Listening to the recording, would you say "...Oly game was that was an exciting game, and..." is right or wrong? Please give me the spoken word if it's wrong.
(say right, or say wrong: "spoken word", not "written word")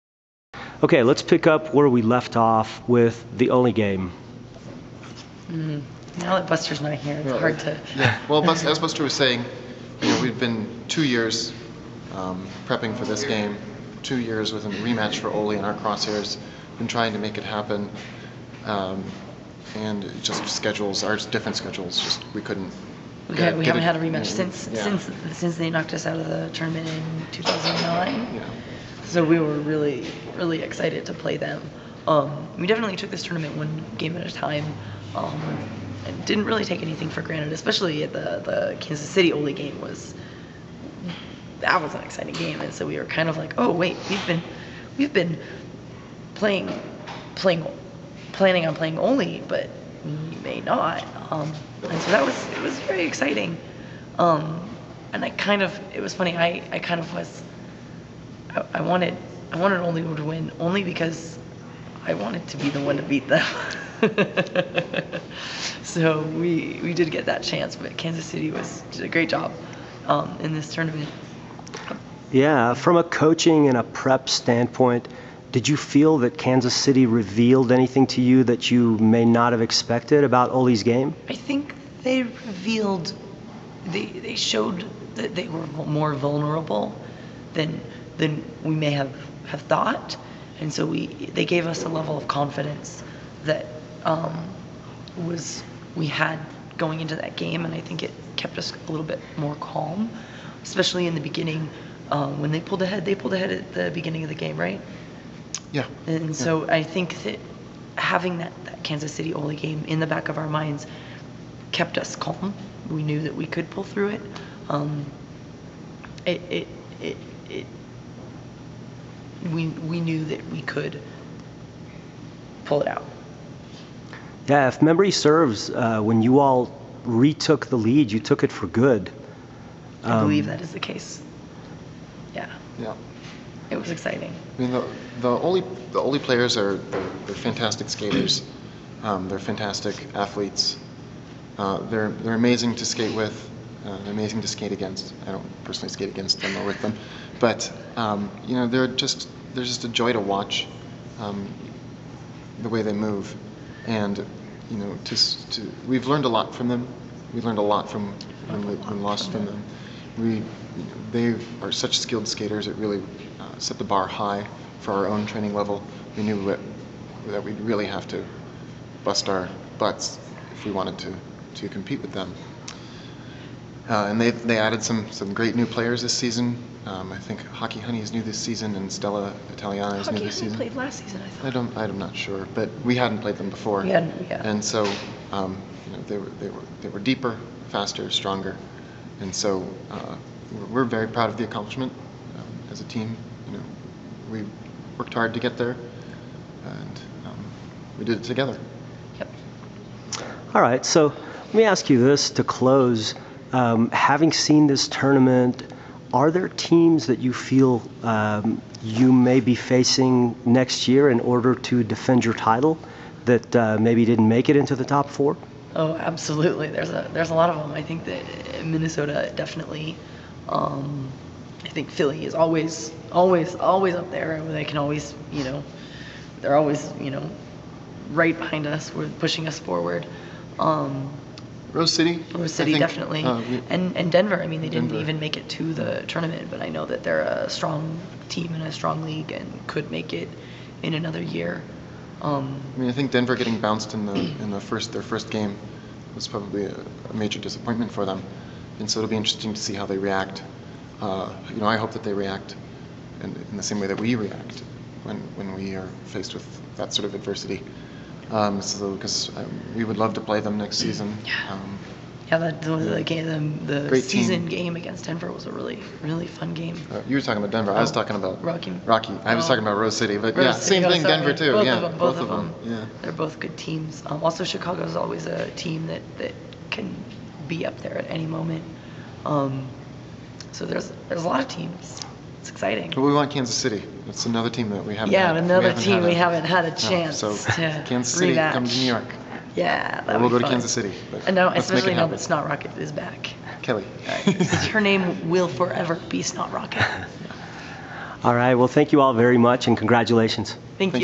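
right.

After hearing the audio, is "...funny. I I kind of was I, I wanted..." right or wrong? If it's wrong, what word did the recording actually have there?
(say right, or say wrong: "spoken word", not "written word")
right.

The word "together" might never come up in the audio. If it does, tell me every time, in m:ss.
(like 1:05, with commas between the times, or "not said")
3:18.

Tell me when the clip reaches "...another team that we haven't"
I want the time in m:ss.
4:44.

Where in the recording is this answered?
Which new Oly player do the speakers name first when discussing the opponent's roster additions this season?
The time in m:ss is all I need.
2:57.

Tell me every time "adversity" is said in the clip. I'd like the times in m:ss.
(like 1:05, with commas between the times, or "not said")
4:17.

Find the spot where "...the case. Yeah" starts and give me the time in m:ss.
2:10.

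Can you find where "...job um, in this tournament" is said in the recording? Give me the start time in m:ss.
1:09.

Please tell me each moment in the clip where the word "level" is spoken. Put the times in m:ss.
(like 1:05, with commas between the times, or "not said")
1:31, 2:45.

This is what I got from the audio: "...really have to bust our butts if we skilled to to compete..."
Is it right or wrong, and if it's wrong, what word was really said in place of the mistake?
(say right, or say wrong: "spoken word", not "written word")
wrong: "wanted", not "skilled".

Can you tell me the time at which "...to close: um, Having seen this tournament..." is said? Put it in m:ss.
3:22.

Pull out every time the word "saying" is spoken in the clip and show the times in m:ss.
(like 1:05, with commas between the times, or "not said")
0:09.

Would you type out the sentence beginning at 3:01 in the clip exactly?
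I'm not sure, but we hadn't played them before.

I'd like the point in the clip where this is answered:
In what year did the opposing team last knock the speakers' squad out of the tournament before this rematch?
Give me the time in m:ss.
0:27.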